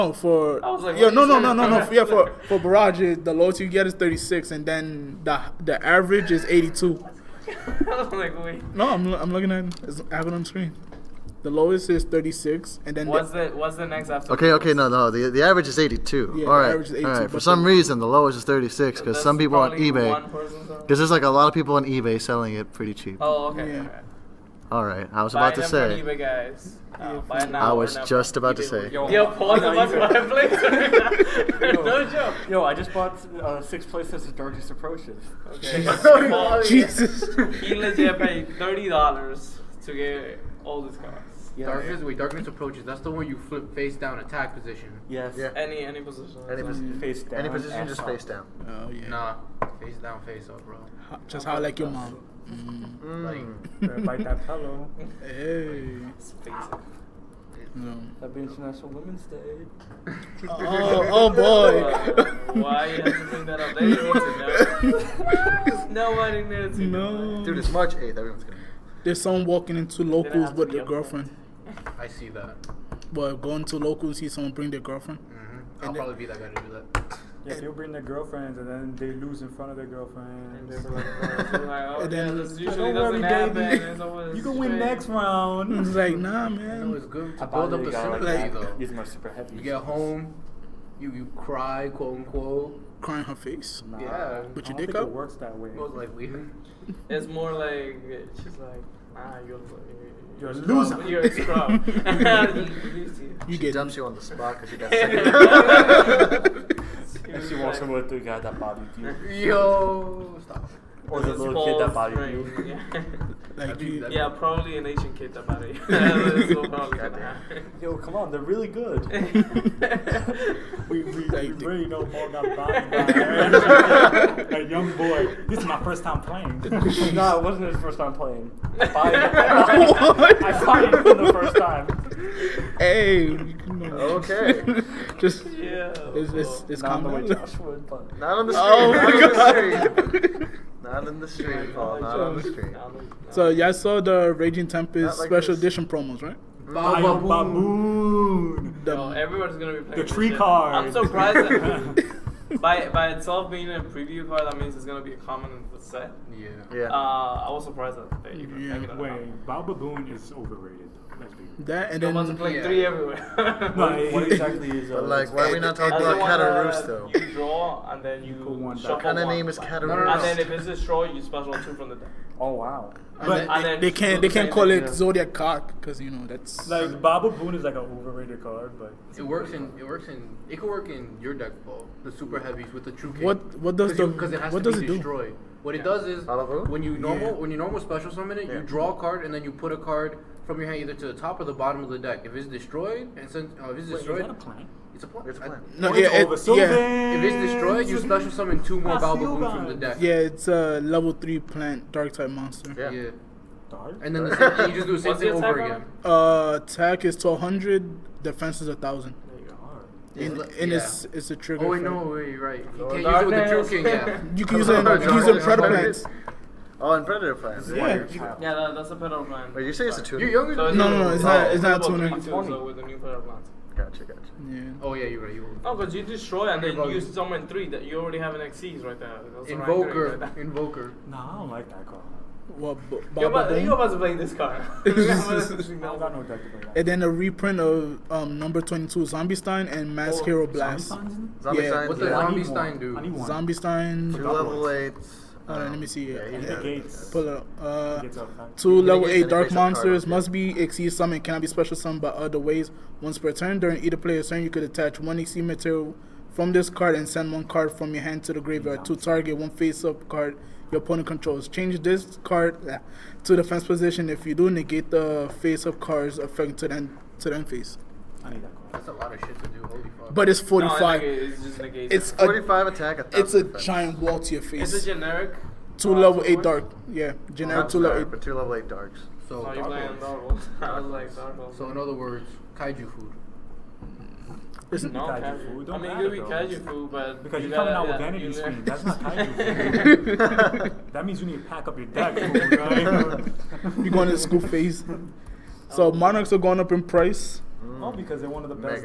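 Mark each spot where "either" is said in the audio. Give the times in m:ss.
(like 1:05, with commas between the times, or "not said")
3:10, 4:13.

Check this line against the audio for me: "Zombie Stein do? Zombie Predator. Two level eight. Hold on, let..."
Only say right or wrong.
wrong.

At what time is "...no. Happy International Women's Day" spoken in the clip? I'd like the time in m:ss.
0:57.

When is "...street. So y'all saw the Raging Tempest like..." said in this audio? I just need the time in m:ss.
2:22.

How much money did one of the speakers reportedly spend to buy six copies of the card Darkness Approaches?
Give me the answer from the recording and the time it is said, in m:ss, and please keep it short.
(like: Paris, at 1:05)
30 dollars, at 0:38.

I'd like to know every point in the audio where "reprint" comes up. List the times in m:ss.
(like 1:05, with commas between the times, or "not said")
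3:57.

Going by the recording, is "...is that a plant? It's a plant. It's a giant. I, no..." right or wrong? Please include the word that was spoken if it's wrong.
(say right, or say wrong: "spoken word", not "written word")
wrong: "plant", not "giant".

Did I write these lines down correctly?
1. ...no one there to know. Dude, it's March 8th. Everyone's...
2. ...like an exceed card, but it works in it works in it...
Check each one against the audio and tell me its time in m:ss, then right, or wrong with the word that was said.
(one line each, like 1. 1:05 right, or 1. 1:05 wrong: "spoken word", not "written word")
1. 1:05 right
2. 2:57 wrong: "overrated", not "exceed".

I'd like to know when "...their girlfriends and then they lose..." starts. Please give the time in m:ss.
1:17.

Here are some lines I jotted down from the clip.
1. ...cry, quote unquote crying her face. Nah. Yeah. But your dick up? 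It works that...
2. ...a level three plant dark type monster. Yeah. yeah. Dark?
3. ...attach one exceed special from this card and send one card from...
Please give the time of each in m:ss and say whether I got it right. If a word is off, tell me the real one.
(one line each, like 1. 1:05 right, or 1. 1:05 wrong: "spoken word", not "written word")
1. 1:31 right
2. 3:20 right
3. 4:14 wrong: "material", not "special".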